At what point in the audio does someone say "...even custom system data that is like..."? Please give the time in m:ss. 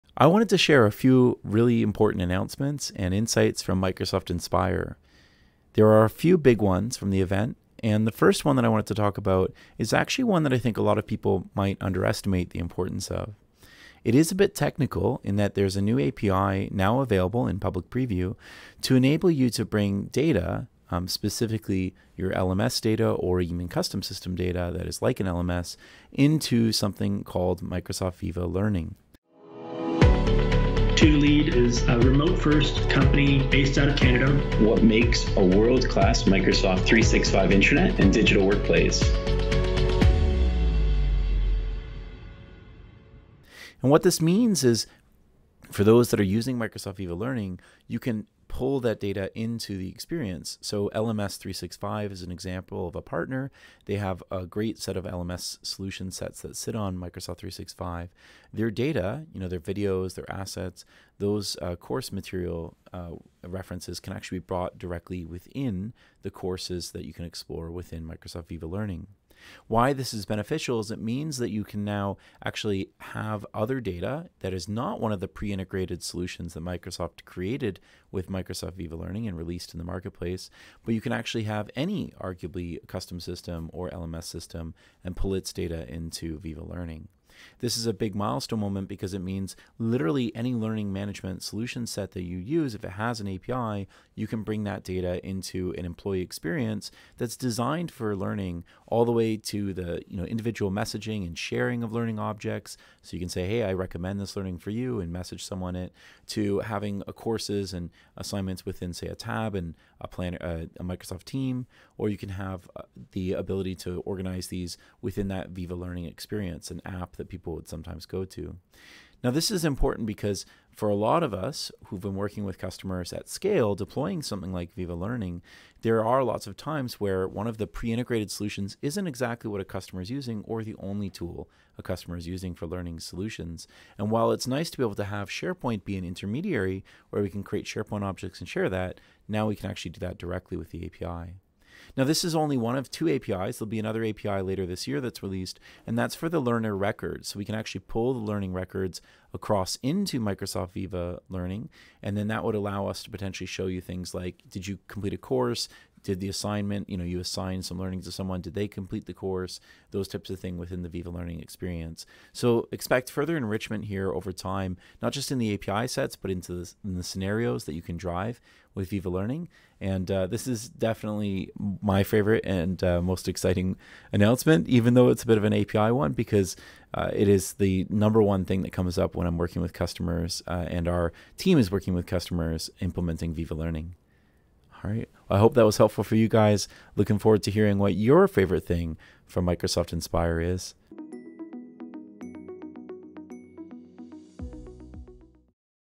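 0:23.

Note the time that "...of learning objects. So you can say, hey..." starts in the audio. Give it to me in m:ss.
1:41.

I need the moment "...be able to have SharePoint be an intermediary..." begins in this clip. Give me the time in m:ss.
2:14.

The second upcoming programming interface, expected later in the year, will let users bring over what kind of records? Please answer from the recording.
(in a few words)
Learner records.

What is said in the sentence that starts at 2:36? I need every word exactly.
Did the assignment, you know, you assign some learning to someone, did they complete the course?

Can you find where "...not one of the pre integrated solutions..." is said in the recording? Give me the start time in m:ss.
1:14.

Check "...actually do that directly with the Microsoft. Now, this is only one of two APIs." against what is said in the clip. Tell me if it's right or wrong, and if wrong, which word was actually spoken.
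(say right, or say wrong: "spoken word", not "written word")
wrong: "API", not "Microsoft".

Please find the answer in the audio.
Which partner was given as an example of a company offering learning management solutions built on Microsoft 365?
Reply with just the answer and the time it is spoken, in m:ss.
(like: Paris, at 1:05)
LMS 365, at 0:50.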